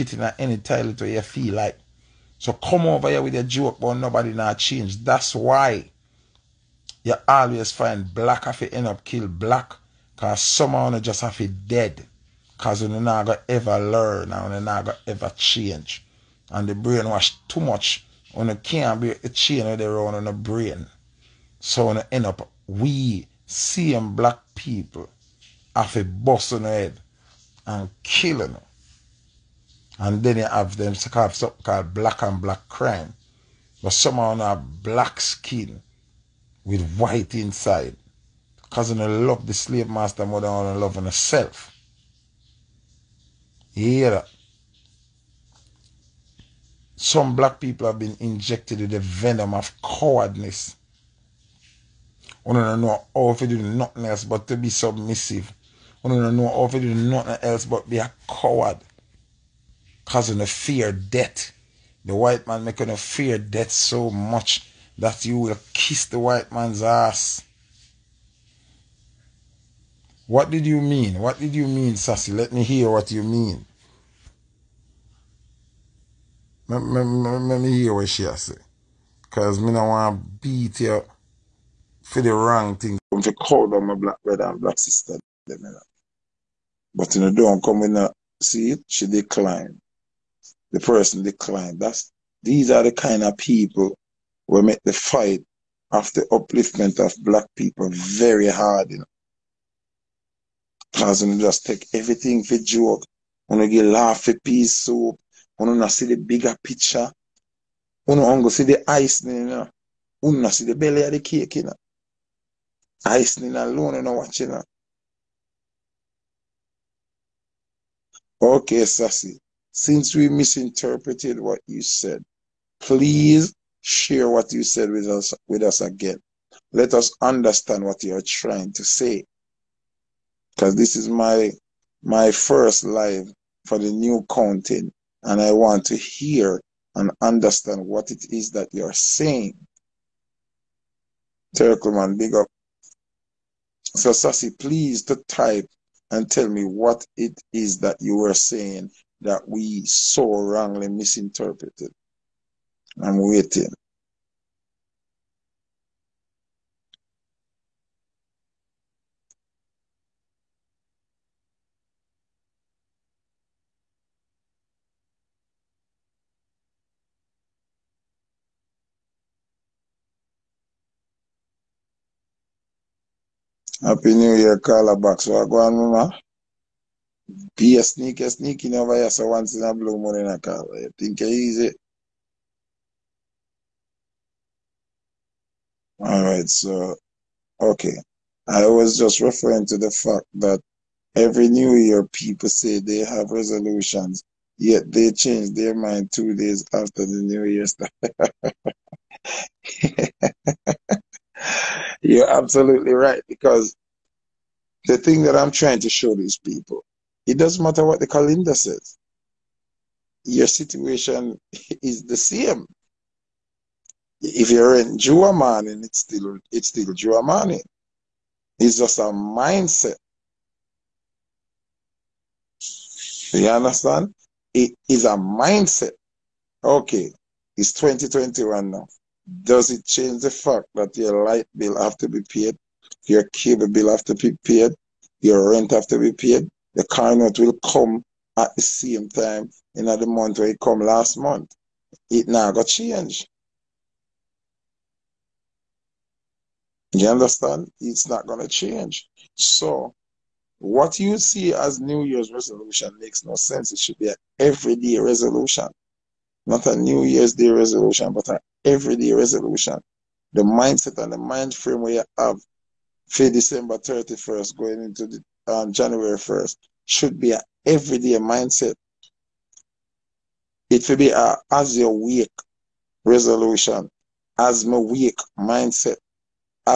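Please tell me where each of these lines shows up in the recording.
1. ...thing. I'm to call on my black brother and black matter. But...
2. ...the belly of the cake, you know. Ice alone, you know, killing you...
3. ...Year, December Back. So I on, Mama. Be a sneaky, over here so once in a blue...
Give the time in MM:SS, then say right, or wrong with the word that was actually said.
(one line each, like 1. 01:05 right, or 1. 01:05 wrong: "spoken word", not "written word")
1. 01:22 wrong: "sister", not "matter"
2. 01:50 wrong: "watching", not "killing"
3. 02:54 wrong: "Carla", not "December".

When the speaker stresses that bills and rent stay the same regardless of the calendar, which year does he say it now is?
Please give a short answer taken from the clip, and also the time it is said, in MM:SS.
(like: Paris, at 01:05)
2021, at 03:47.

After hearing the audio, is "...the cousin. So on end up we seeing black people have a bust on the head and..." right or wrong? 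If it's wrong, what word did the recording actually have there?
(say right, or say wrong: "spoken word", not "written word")
wrong: "brain", not "cousin".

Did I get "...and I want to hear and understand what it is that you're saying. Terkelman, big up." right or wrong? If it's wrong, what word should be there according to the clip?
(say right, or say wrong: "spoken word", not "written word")
right.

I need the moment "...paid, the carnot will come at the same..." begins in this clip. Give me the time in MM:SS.
03:56.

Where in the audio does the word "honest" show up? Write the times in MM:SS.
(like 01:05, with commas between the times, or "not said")
not said.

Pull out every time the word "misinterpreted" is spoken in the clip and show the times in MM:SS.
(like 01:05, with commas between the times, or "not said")
02:00, 02:30.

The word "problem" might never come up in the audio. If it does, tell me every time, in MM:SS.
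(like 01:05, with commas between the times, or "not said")
not said.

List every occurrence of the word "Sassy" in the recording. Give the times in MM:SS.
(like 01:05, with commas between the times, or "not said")
01:11, 01:58, 02:24.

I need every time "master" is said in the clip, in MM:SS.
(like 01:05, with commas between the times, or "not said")
00:39.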